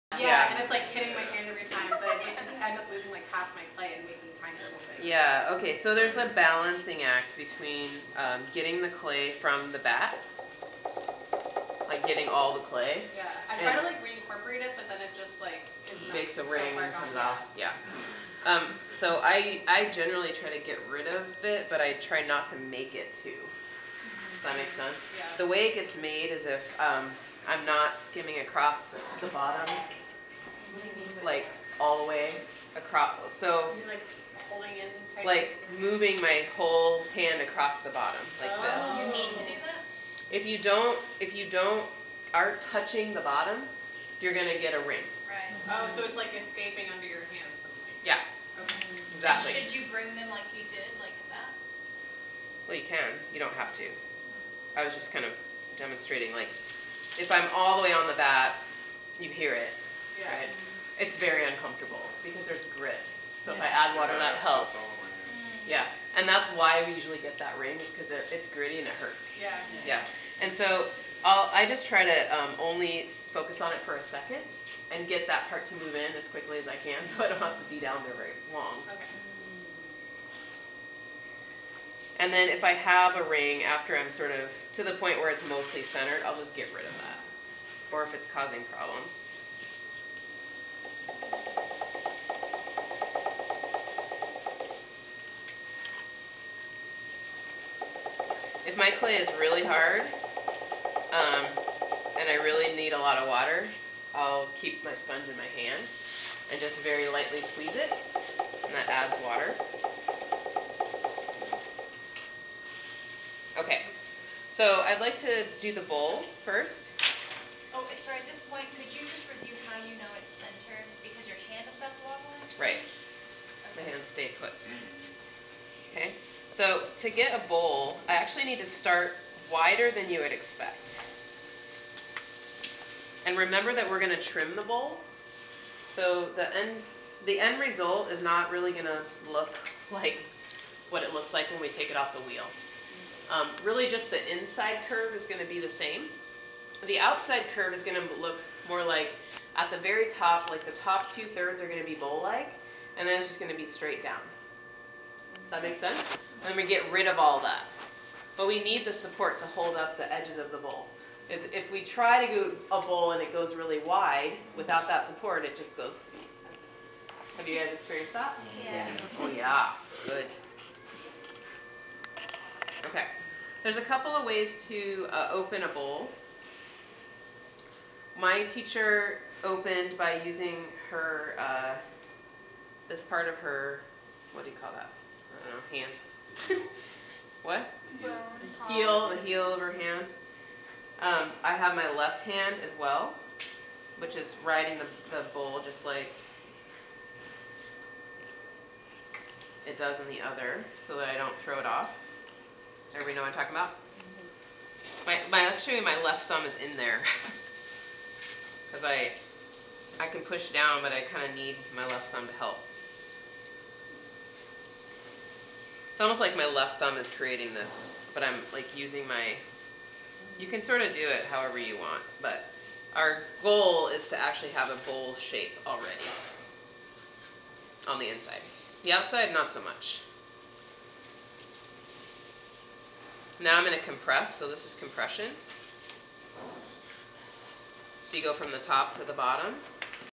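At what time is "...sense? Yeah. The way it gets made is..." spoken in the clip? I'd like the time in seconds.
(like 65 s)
24 s.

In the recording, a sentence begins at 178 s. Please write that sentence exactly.
My teacher opened by using her, uh, this part of her, what do you call that?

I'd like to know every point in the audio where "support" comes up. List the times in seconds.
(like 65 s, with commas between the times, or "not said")
158 s, 165 s.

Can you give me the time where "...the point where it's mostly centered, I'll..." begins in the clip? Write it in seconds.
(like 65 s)
84 s.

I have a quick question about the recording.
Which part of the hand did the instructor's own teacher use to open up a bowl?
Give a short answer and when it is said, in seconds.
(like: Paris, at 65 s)
heel of her hand, at 189 s.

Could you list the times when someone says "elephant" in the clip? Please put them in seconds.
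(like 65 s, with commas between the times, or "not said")
not said.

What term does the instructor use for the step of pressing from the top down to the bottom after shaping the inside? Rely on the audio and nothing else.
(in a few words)
compression.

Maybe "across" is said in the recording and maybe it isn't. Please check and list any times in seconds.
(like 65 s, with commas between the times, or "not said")
28 s, 32 s, 37 s.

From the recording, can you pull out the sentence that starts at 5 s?
Yeah, okay, so there's a balancing act between um, getting the clay from the bat, like getting all the clay.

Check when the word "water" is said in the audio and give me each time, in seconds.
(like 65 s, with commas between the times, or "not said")
63 s, 103 s, 109 s.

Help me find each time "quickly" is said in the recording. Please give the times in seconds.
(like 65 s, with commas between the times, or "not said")
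76 s.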